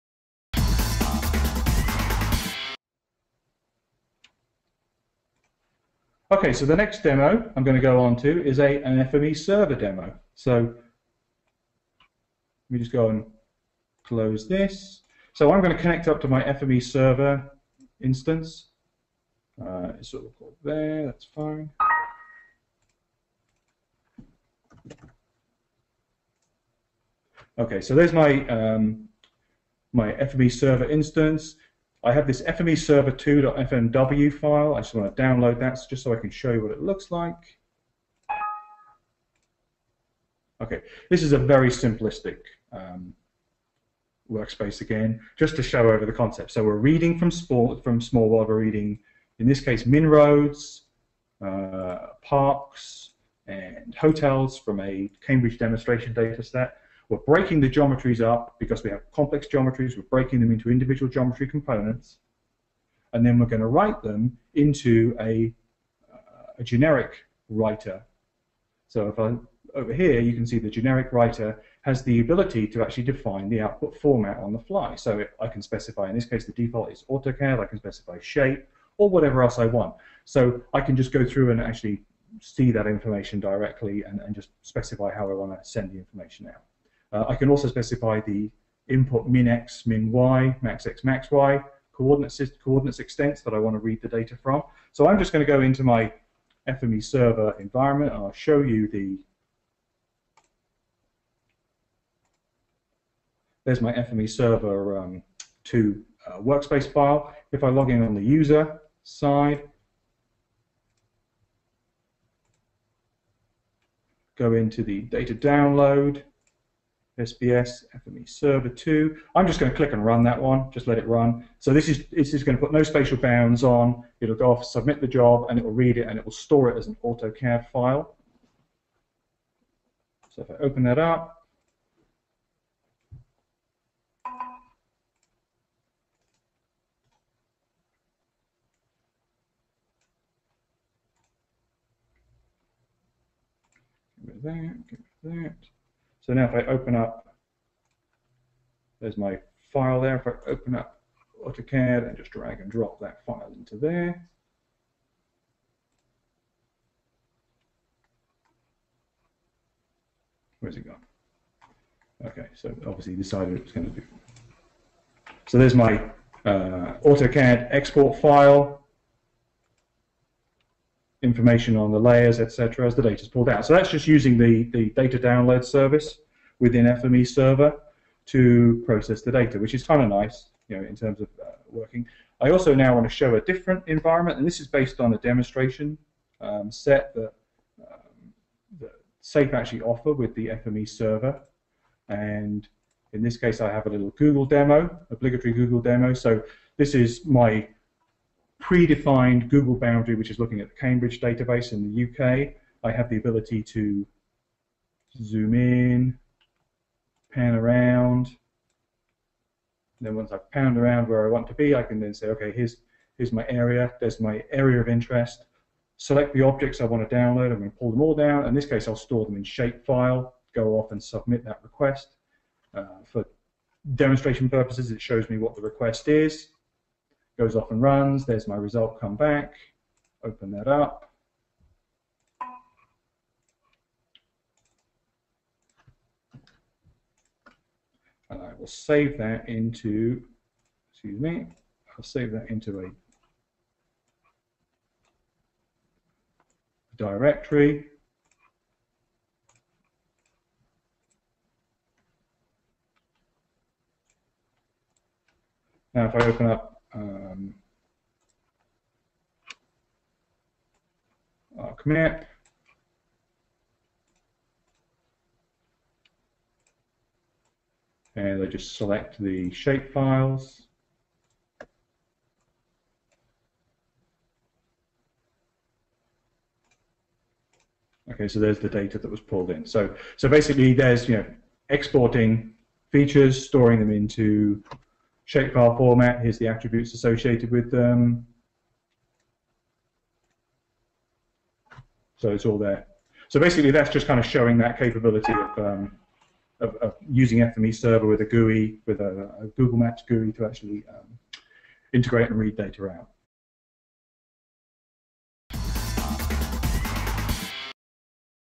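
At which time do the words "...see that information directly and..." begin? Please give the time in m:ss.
1:22.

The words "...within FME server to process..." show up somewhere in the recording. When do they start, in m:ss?
2:56.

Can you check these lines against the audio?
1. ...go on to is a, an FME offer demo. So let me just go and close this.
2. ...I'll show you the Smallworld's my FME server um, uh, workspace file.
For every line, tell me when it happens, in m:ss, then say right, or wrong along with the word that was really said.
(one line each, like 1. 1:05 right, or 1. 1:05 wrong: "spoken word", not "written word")
1. 0:07 wrong: "server", not "offer"
2. 1:38 wrong: "There", not "Smallworld".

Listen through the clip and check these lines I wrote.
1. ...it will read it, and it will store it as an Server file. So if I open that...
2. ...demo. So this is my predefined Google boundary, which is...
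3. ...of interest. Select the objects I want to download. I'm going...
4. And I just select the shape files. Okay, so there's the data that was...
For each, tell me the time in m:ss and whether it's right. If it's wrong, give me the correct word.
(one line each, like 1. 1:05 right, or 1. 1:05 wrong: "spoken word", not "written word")
1. 2:05 wrong: "AutoCAD", not "Server"
2. 3:15 right
3. 3:34 right
4. 4:28 right.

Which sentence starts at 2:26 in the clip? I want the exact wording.
So now if I open up, there's my file there.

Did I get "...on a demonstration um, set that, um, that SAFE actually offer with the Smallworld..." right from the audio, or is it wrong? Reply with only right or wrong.
wrong.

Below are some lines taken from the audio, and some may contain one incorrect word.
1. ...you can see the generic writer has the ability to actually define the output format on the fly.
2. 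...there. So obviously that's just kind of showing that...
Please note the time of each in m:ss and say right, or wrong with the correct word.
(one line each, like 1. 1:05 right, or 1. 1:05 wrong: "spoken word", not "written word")
1. 1:10 right
2. 4:52 wrong: "basically", not "obviously".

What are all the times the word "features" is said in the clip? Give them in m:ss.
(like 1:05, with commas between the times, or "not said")
4:42.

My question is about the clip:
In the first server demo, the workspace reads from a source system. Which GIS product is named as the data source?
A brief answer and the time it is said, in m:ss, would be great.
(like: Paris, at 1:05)
Smallworld, at 0:47.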